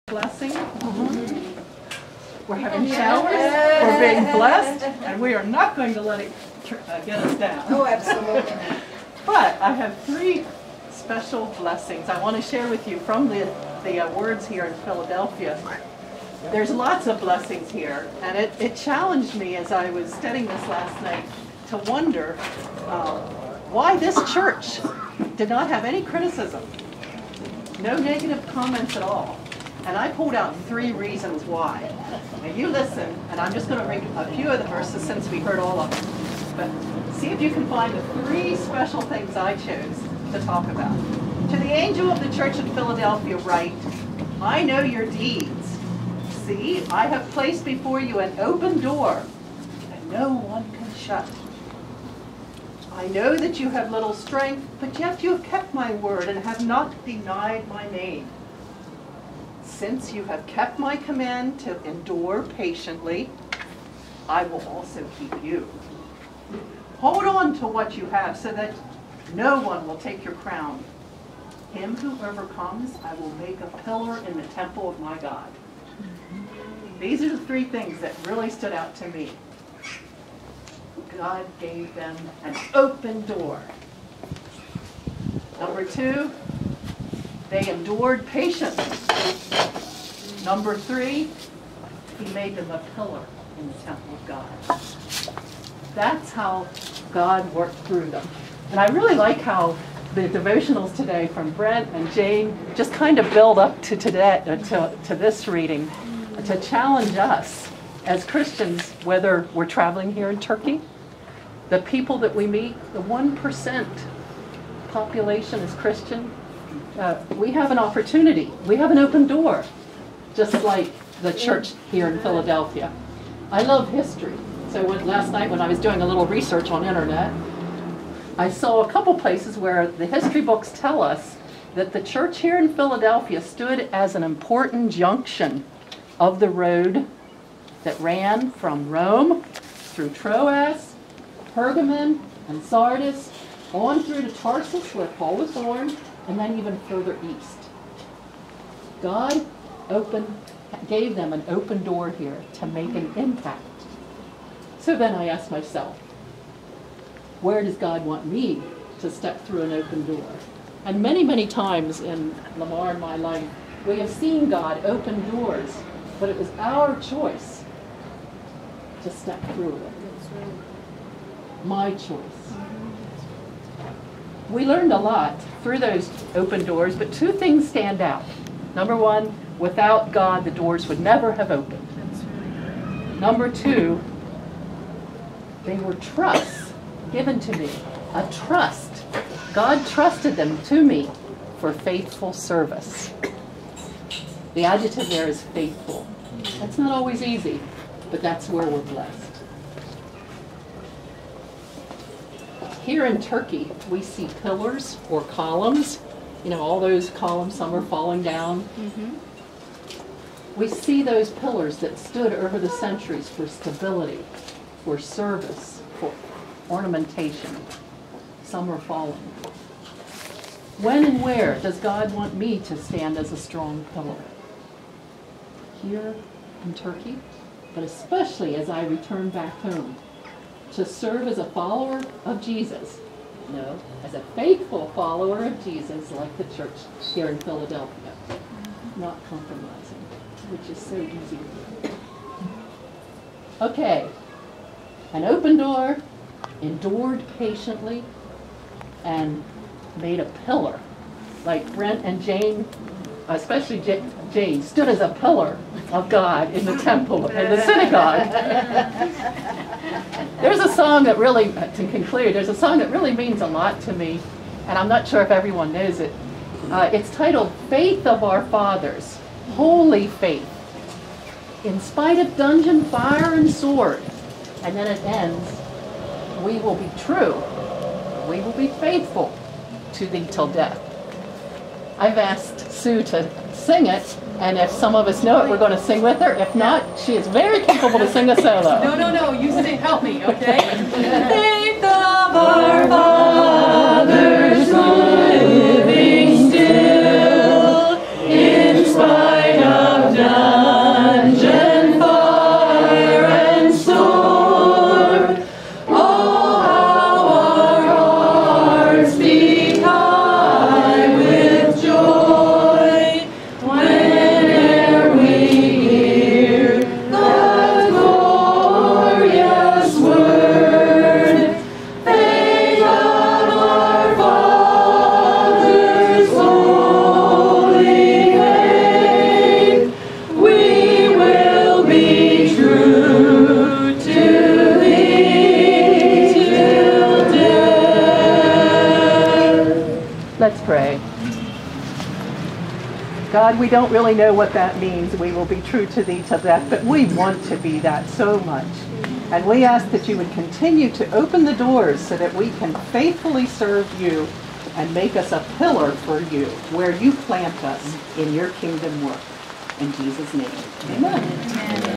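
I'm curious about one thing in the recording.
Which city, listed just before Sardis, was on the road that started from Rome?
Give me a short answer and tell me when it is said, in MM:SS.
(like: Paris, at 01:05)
Pergamon, at 02:21.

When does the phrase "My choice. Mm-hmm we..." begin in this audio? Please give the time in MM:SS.
02:51.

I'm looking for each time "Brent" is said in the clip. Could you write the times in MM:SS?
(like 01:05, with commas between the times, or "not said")
01:41, 04:11.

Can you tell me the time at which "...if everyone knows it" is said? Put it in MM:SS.
04:25.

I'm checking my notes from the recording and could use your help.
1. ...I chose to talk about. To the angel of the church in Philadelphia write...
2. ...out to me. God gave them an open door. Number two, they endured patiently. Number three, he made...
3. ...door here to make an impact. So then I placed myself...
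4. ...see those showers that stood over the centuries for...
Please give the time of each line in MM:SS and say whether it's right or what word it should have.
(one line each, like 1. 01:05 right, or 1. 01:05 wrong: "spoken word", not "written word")
1. 00:39 right
2. 01:18 right
3. 02:31 wrong: "asked", not "placed"
4. 03:30 wrong: "pillars", not "showers".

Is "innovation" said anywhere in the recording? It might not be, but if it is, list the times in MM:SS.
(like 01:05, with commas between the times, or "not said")
not said.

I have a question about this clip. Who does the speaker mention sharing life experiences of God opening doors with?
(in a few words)
Lamar.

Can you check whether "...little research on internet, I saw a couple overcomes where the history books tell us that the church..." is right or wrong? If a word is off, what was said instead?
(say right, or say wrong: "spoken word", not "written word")
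wrong: "places", not "overcomes".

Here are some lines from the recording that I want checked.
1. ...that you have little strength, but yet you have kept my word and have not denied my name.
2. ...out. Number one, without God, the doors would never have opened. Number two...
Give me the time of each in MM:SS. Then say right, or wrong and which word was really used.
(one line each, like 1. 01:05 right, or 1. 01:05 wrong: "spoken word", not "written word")
1. 00:53 right
2. 02:58 right.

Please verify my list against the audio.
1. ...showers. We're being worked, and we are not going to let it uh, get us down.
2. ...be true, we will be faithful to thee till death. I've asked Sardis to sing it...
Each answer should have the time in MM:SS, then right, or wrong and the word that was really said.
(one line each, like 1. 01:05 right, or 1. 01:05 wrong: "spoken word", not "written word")
1. 00:02 wrong: "blessed", not "worked"
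2. 04:36 wrong: "Sue", not "Sardis".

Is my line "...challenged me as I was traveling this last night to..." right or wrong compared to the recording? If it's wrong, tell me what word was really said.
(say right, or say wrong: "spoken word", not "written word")
wrong: "studying", not "traveling".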